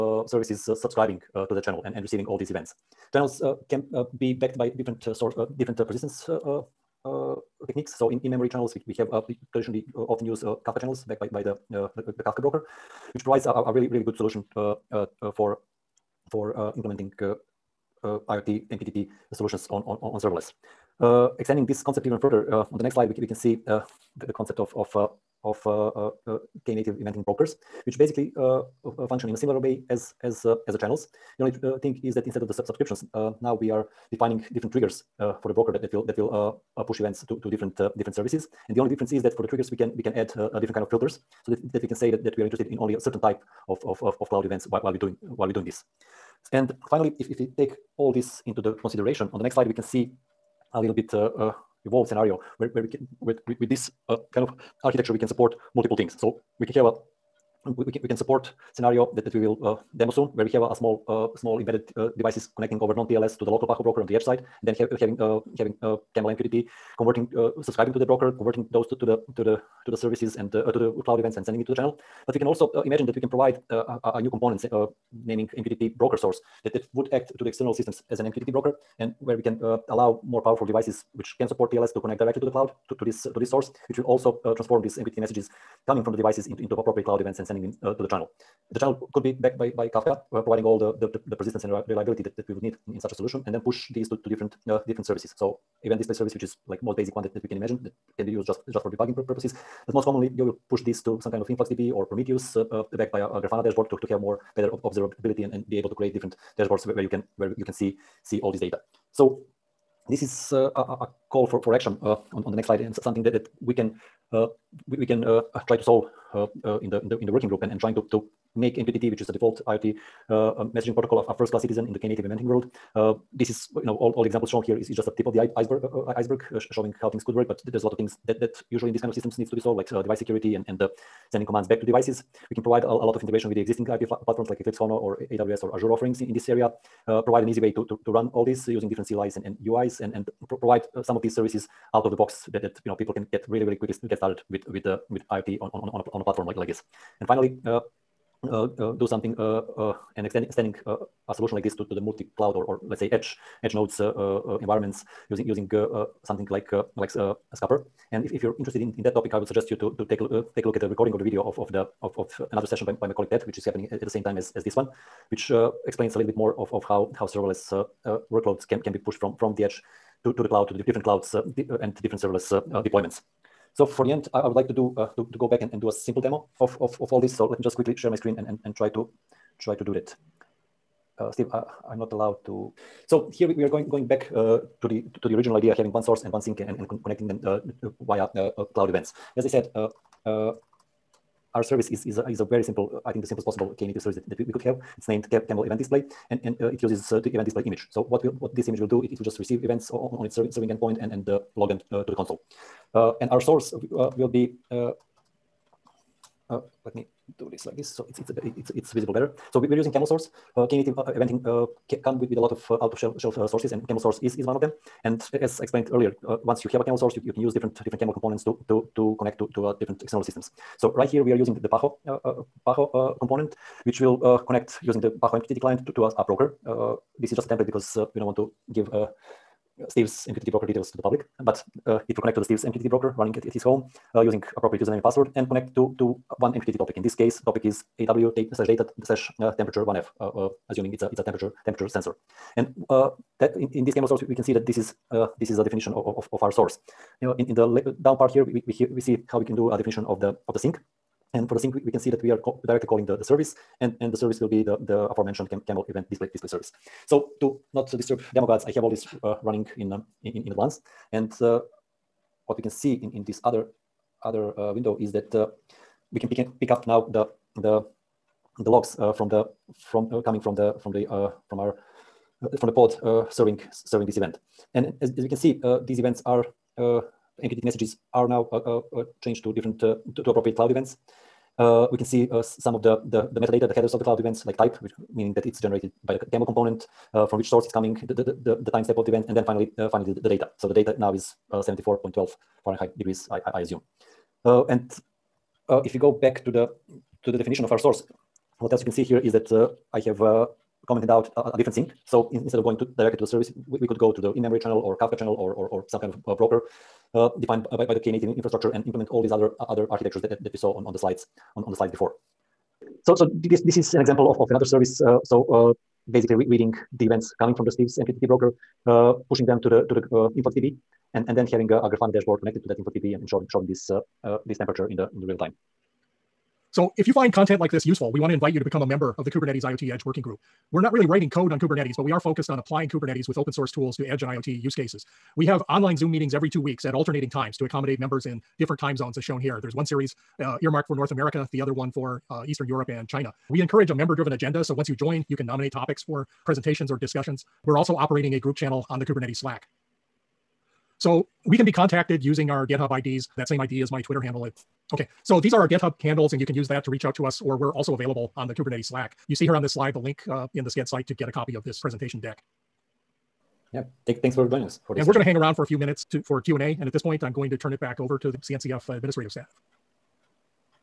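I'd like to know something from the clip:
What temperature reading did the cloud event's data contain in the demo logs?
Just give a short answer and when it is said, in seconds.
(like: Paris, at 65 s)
74.12 Fahrenheit, at 291 s.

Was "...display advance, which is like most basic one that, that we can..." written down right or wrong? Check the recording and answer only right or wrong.
wrong.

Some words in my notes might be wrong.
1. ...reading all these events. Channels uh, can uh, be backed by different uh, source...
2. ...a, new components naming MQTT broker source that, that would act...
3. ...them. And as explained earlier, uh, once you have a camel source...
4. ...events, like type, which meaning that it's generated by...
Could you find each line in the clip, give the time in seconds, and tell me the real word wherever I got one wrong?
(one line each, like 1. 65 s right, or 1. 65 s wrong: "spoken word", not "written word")
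1. 2 s wrong: "receiving", not "reading"
2. 74 s right
3. 214 s right
4. 284 s right.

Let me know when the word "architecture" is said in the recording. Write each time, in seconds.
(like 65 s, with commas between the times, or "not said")
54 s, 309 s.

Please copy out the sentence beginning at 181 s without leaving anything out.
Uh, Steve, uh, I'm not allowed to.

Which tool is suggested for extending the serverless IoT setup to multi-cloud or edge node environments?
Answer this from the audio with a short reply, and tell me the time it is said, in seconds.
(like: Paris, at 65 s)
Skupper, at 157 s.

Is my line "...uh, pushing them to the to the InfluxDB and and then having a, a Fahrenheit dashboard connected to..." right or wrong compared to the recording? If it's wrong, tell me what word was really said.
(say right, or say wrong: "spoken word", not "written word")
wrong: "Grafana", not "Fahrenheit".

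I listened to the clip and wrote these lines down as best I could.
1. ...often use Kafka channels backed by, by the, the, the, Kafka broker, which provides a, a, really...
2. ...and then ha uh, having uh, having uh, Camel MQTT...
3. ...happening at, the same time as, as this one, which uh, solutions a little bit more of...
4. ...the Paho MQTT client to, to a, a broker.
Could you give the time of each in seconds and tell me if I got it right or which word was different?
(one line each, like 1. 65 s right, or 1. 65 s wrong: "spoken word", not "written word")
1. 9 s right
2. 64 s right
3. 163 s wrong: "explains", not "solutions"
4. 225 s right.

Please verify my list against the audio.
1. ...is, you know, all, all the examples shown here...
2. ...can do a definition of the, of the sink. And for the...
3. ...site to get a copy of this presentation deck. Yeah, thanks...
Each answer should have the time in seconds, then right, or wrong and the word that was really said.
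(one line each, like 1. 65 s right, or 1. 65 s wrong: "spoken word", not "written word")
1. 123 s right
2. 249 s right
3. 360 s right.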